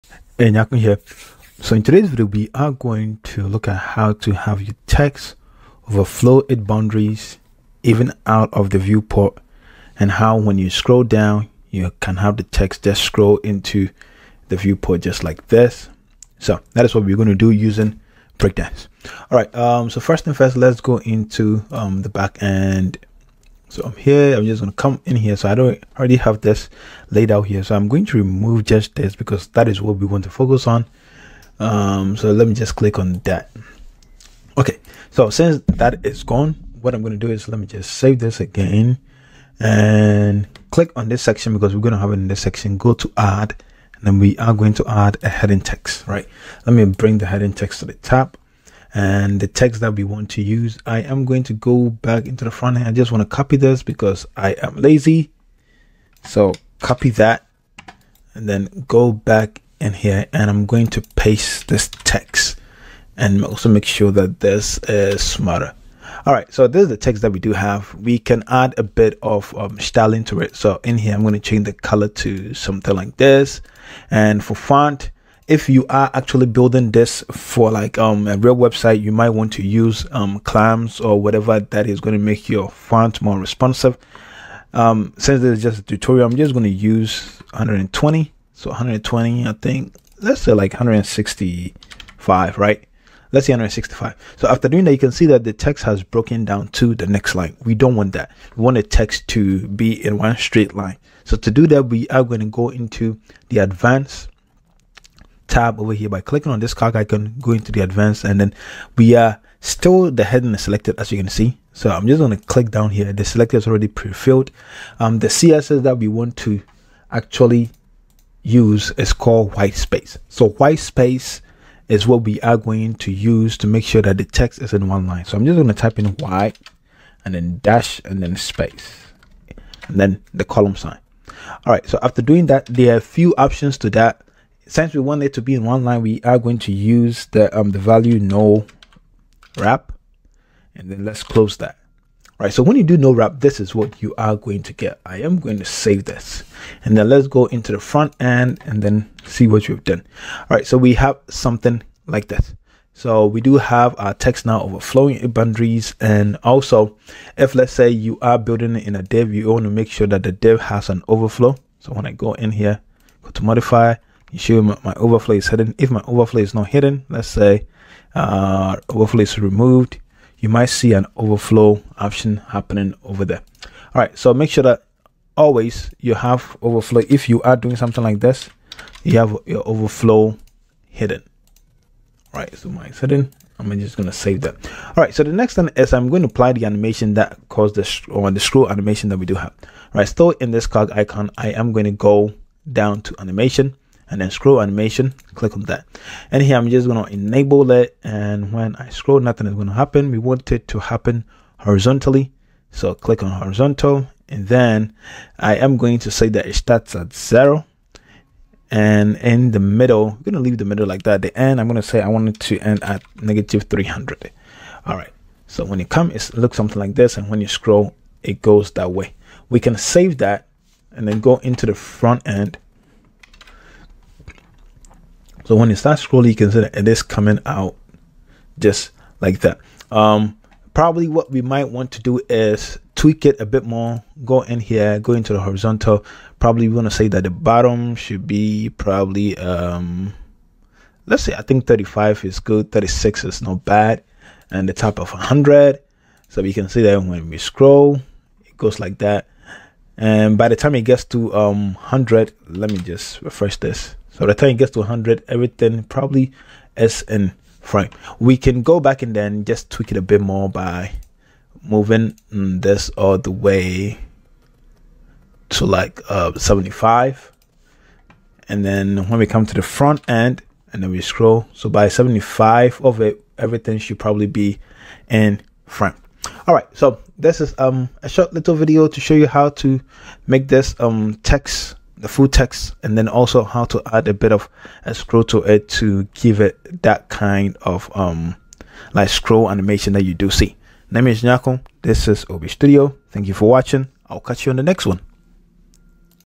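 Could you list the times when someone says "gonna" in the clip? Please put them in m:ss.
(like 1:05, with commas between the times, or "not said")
0:24, 0:37.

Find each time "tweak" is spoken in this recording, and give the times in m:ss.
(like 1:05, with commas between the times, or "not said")
3:52, 4:19.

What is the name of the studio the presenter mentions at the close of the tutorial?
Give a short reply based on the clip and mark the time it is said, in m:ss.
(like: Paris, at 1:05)
OB Studio, at 4:52.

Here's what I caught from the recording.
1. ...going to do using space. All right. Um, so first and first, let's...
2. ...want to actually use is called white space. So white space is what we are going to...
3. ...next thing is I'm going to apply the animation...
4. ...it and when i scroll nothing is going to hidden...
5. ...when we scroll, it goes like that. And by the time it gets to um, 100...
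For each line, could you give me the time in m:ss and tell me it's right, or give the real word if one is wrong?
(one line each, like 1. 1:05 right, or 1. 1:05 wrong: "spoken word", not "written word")
1. 0:17 wrong: "breakdance", not "space"
2. 1:56 right
3. 3:05 right
4. 3:17 wrong: "happen", not "hidden"
5. 4:07 right.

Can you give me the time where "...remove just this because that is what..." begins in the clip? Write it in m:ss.
0:28.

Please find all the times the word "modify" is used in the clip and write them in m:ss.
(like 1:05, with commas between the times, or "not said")
2:43.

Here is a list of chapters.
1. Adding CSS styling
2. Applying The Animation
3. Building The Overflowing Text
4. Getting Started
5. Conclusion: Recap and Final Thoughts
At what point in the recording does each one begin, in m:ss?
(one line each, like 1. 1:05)
1. 1:34
2. 3:04
3. 0:39
4. 0:21
5. 4:37.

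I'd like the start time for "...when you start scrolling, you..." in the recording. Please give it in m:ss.
3:45.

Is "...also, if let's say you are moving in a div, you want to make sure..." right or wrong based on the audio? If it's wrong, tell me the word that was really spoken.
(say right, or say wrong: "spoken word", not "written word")
wrong: "building", not "moving".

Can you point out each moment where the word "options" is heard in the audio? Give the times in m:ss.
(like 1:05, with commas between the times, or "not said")
2:13, 2:51.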